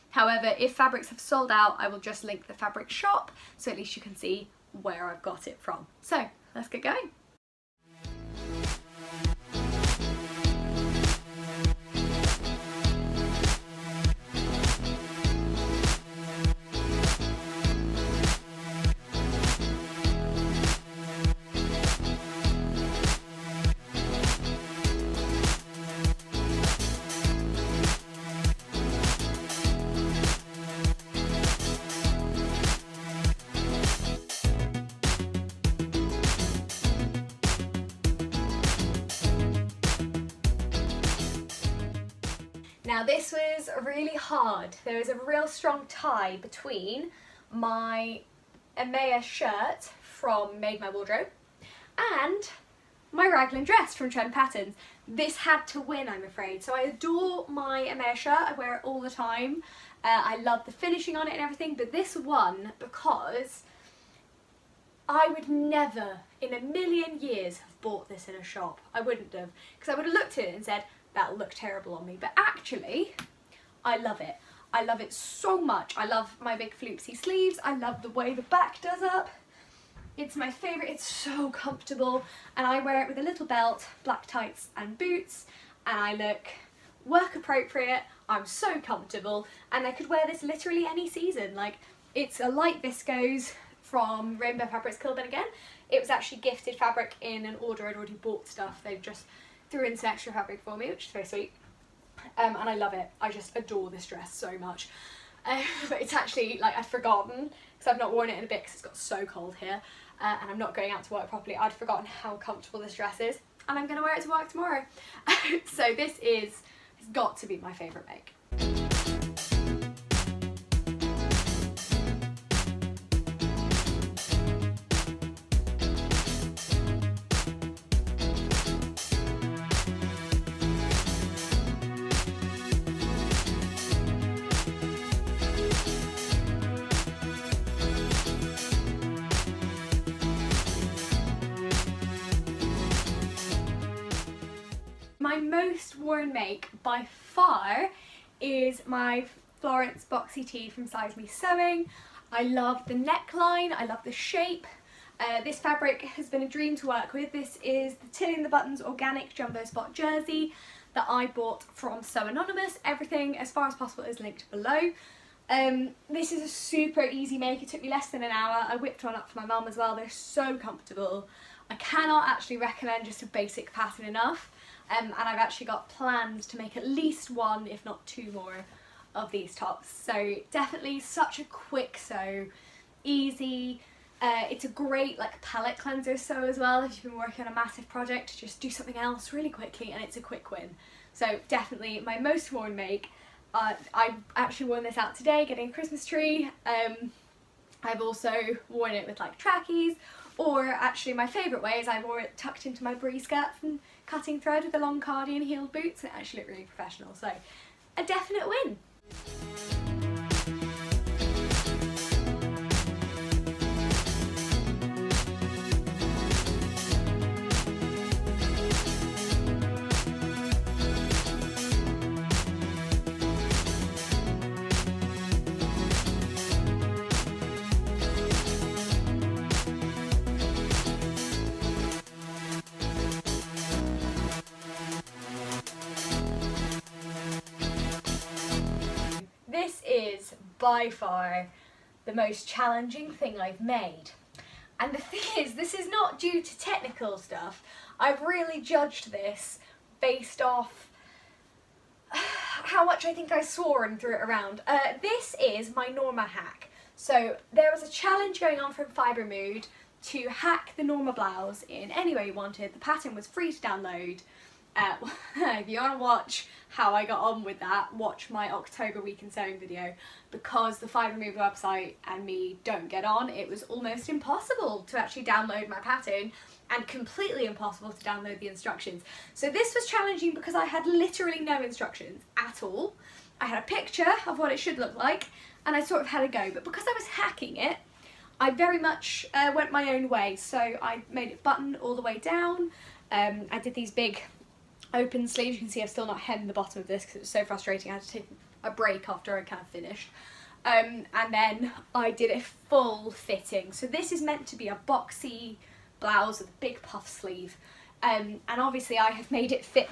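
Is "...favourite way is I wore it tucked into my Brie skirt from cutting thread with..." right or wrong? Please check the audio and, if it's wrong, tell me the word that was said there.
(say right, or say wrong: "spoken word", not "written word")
right.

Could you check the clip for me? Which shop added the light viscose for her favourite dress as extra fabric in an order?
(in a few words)
Rainbow Fabrics Kilburn.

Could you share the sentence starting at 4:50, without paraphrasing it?
So I made it button all the way down.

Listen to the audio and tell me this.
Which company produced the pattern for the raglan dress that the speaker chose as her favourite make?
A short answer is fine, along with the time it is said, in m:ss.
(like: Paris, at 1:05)
Trend Patterns, at 0:54.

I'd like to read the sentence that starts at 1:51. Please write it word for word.
I'd forgotten how comfortable this dress is, and I'm going to wear it to work tomorrow.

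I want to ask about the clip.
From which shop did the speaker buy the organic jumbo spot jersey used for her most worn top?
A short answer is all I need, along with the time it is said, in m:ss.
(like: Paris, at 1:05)
So Anonymous, at 2:42.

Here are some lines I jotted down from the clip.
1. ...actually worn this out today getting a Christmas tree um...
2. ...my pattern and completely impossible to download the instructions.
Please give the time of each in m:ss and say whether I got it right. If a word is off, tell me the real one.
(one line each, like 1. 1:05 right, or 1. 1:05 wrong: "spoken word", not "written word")
1. 3:14 right
2. 4:35 right.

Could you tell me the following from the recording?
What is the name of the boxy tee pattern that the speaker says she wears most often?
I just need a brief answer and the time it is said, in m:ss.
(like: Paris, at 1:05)
Florence, at 2:29.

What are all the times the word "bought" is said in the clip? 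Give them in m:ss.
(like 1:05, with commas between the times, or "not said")
1:07, 1:38, 2:41.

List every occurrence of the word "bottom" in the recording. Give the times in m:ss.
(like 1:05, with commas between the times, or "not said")
4:56.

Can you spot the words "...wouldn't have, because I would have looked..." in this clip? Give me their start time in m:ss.
1:09.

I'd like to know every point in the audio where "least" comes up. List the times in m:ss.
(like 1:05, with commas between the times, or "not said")
0:03, 2:56.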